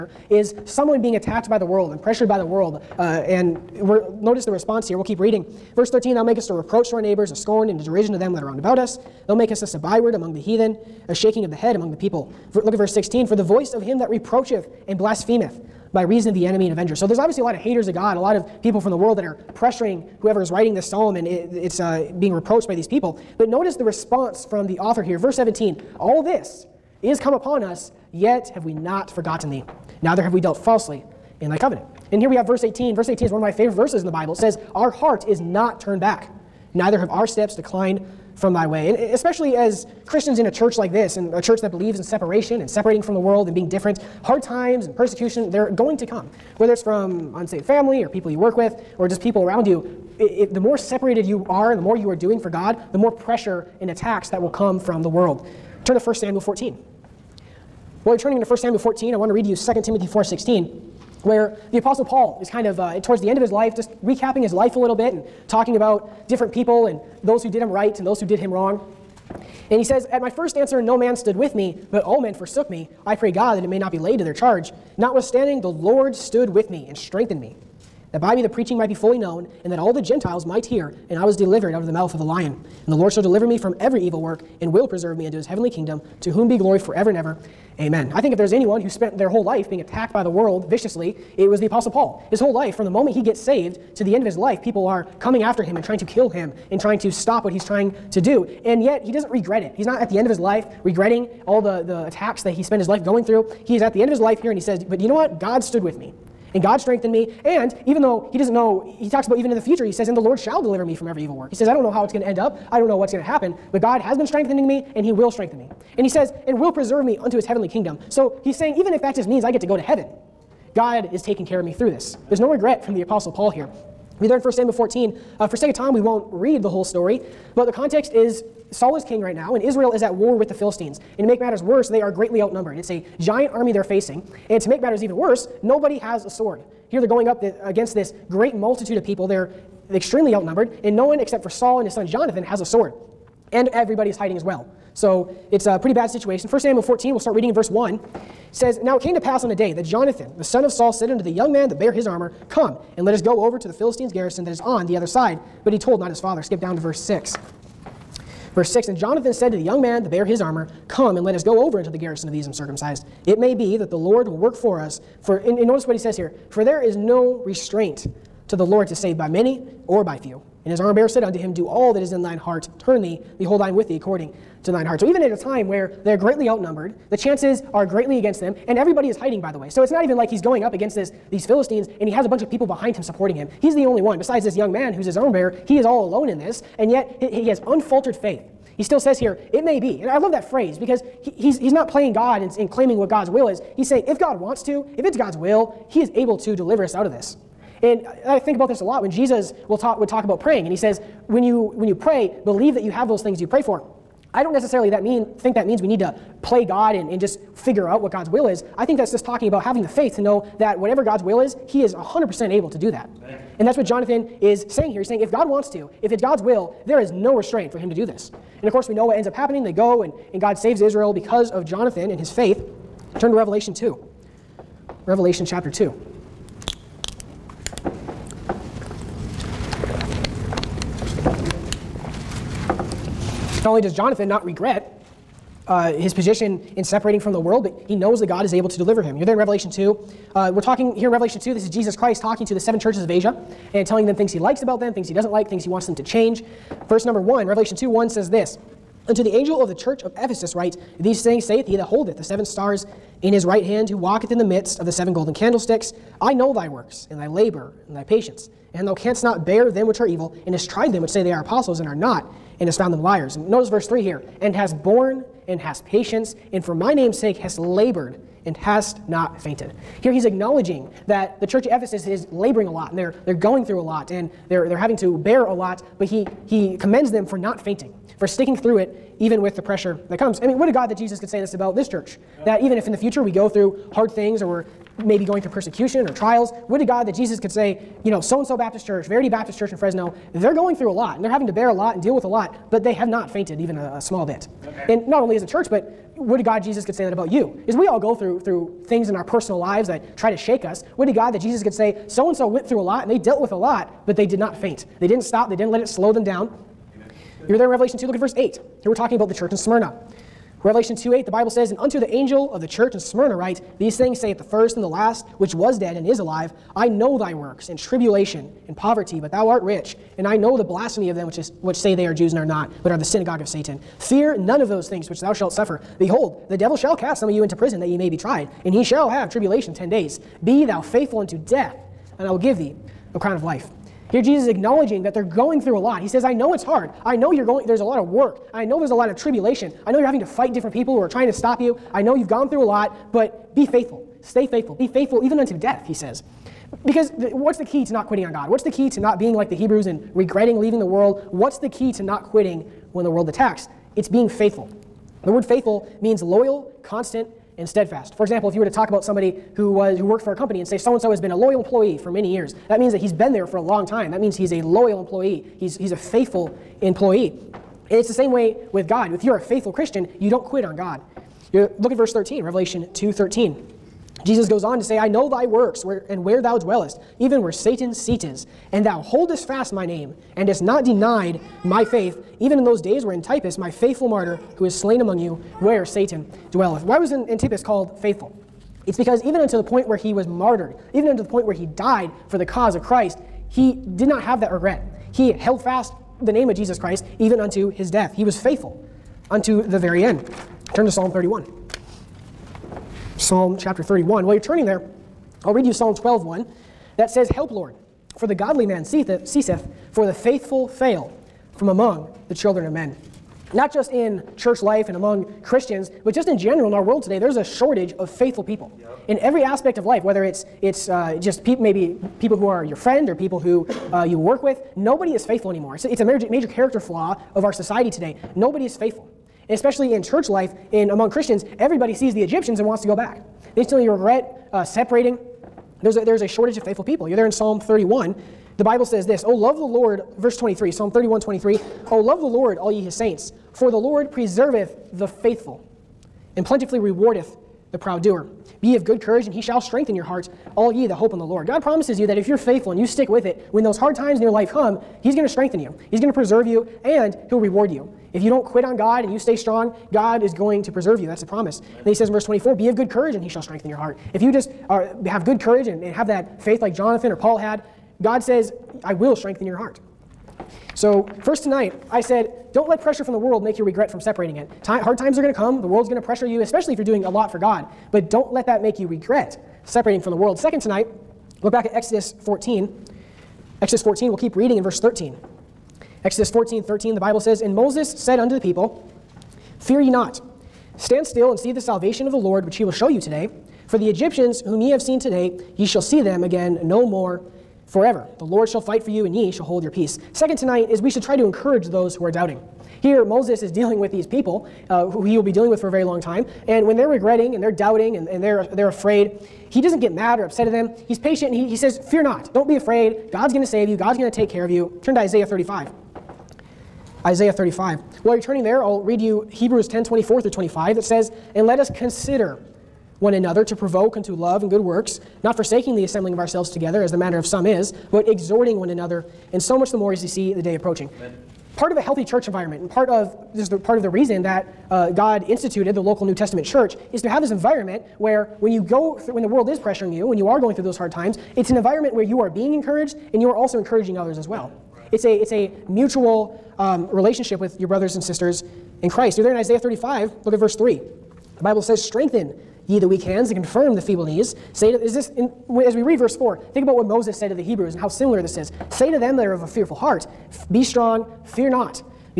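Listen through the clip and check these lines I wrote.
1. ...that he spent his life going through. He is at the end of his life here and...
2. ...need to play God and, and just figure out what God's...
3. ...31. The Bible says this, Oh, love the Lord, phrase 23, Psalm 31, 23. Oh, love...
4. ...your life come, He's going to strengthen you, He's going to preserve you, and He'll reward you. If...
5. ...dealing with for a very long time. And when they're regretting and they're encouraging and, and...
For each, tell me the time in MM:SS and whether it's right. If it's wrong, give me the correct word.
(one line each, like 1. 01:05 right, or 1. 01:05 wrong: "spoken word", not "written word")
1. 01:42 right
2. 03:25 right
3. 07:17 wrong: "verse", not "phrase"
4. 07:34 right
5. 08:25 wrong: "doubting", not "encouraging".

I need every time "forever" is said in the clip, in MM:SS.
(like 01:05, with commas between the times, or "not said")
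01:26, 08:17.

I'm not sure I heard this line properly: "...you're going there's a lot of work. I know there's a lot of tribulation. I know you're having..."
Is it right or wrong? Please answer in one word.
right.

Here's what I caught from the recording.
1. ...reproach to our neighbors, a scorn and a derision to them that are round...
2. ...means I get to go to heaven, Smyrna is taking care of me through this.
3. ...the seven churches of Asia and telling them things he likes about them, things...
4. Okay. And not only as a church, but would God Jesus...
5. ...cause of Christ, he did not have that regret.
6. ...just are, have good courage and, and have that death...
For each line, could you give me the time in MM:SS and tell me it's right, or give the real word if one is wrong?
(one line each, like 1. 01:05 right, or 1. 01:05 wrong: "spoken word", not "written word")
1. 00:06 right
2. 01:59 wrong: "God", not "Smyrna"
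3. 04:02 right
4. 04:54 right
5. 06:32 right
6. 07:44 wrong: "faith", not "death".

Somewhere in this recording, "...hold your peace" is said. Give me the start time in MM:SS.
08:19.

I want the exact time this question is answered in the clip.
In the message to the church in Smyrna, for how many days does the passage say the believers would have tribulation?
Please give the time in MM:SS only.
05:29.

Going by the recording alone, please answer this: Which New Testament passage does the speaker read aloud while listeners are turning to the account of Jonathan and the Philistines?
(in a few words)
2 Timothy 4:16.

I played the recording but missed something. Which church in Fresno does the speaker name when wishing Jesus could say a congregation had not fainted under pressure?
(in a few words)
Verity Baptist Church.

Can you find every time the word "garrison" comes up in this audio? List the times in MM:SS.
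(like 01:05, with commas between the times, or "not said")
02:34, 02:41.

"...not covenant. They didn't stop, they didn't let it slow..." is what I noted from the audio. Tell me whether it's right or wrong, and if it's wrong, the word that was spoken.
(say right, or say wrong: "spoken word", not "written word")
wrong: "faint", not "covenant".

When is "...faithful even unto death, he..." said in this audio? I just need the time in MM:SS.
05:44.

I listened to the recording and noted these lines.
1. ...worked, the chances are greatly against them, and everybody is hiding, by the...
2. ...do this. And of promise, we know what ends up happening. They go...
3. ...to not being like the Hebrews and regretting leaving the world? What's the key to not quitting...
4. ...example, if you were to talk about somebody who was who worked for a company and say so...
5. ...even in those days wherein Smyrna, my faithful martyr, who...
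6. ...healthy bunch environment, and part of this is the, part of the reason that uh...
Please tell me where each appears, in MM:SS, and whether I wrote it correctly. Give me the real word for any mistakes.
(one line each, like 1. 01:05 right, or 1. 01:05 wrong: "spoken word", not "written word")
1. 02:56 wrong: "outnumbered", not "worked"
2. 03:37 wrong: "course", not "promise"
3. 05:48 right
4. 05:58 right
5. 06:22 wrong: "Antipas", not "Smyrna"
6. 08:51 wrong: "church", not "bunch".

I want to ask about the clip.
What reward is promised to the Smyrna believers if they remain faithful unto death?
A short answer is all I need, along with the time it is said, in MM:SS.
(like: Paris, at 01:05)
a crown of life, at 05:33.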